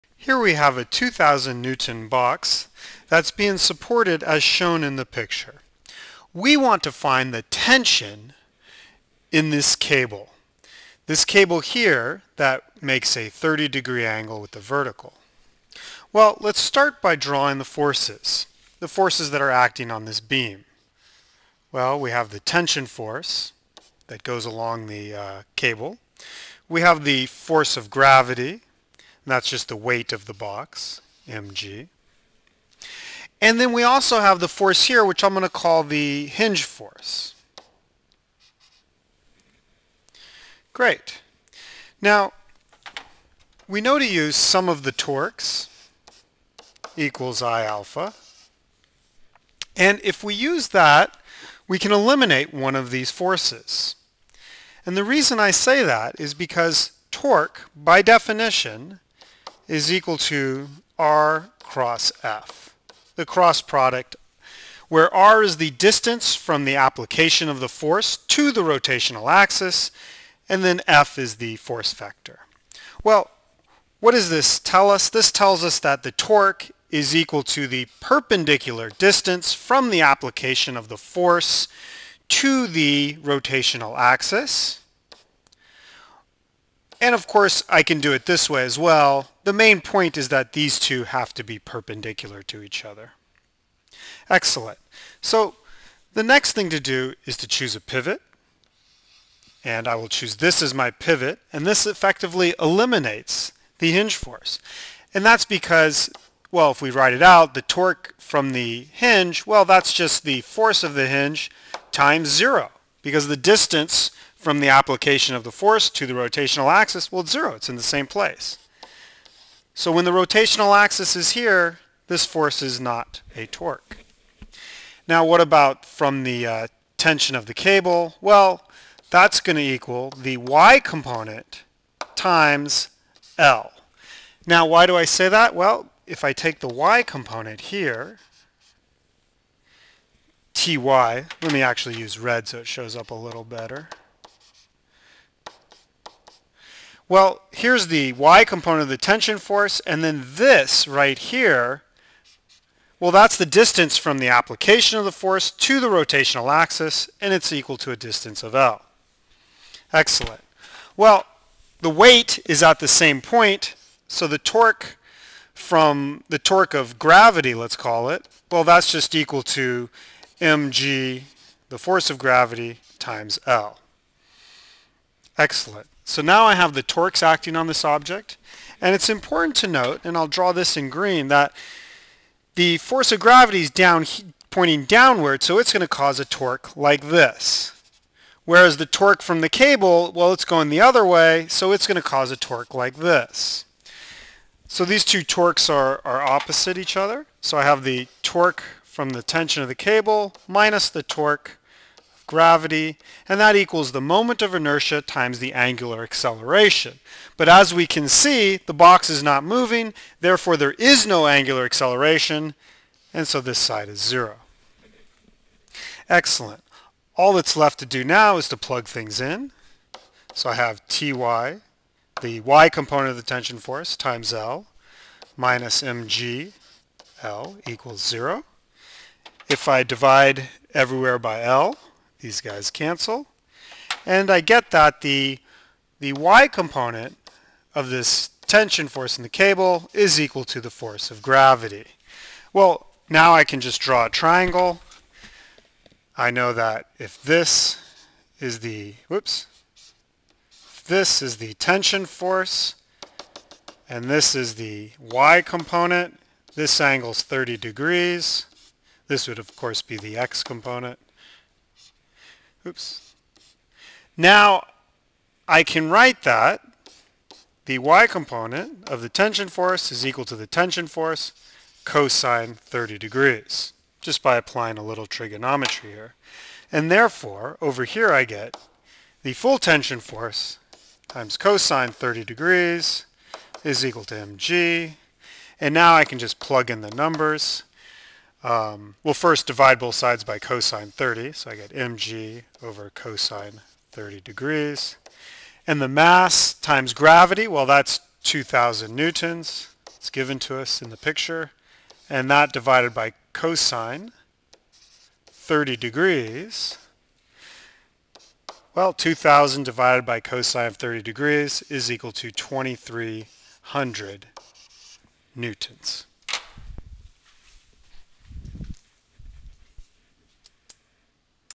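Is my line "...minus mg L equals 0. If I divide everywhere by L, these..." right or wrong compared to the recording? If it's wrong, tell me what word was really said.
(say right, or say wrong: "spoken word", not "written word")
right.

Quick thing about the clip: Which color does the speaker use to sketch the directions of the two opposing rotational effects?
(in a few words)
green.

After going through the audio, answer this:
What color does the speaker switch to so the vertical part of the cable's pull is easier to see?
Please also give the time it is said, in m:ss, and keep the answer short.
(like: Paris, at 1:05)
red, at 2:22.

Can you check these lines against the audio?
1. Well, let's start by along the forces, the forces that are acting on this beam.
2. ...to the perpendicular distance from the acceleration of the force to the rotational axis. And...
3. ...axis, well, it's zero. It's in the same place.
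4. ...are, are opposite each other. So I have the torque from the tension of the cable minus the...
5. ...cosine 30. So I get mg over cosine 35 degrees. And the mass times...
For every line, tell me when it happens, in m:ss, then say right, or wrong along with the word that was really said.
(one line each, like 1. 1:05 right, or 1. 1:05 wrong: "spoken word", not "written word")
1. 0:16 wrong: "drawing", not "along"
2. 1:17 wrong: "application", not "acceleration"
3. 1:56 right
4. 3:15 right
5. 4:50 wrong: "30", not "35".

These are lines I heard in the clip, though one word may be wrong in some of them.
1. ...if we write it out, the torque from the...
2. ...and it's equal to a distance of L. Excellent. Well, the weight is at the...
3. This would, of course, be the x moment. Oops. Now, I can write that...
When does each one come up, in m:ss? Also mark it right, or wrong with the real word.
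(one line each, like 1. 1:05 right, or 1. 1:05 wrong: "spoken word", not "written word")
1. 1:46 right
2. 2:37 right
3. 4:19 wrong: "component", not "moment".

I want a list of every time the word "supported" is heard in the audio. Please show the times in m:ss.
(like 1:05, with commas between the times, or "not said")
0:03.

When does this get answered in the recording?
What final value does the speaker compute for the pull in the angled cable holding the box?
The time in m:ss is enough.
5:12.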